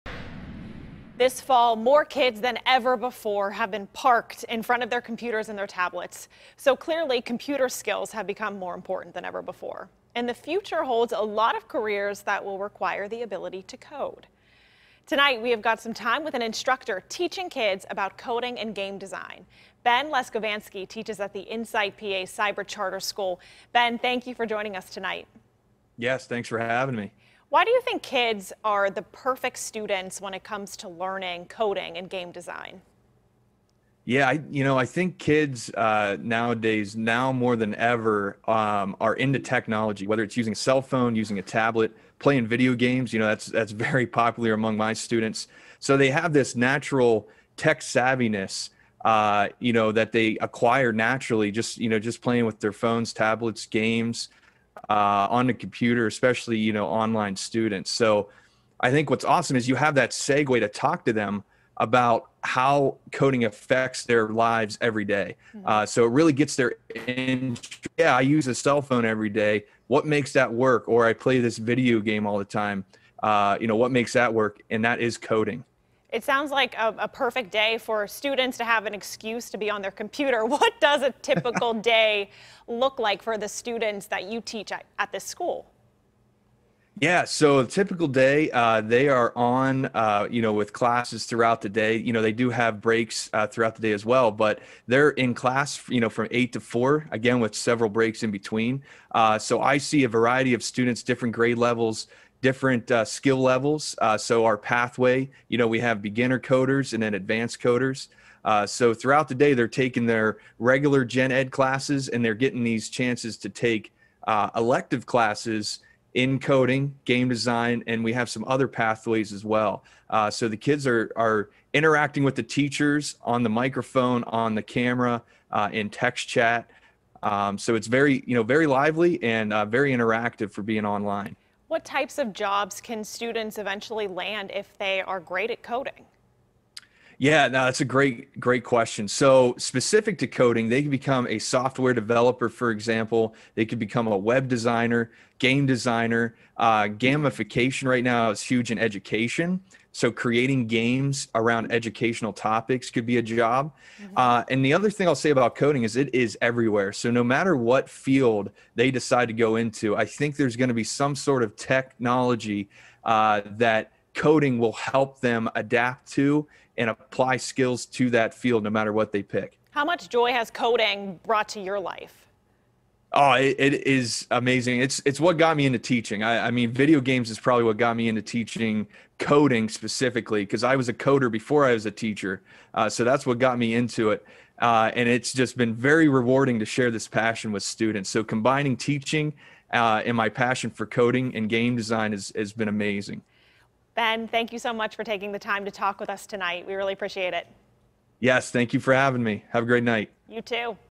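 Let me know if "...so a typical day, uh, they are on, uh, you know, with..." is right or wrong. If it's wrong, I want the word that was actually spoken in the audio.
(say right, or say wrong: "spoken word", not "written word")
right.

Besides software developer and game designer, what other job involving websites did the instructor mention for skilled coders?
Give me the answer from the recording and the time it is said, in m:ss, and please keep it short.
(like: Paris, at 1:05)
Web designer, at 2:24.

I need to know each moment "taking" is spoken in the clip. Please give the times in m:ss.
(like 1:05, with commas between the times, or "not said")
1:49, 3:15.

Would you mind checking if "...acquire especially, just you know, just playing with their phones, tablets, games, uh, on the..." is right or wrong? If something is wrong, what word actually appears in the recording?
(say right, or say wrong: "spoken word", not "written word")
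wrong: "naturally", not "especially".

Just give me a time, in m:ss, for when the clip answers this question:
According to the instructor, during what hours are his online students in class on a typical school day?
1:36.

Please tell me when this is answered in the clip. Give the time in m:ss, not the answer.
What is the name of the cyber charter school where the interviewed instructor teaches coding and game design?
0:21.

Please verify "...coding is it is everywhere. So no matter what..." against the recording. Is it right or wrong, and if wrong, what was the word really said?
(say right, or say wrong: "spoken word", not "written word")
right.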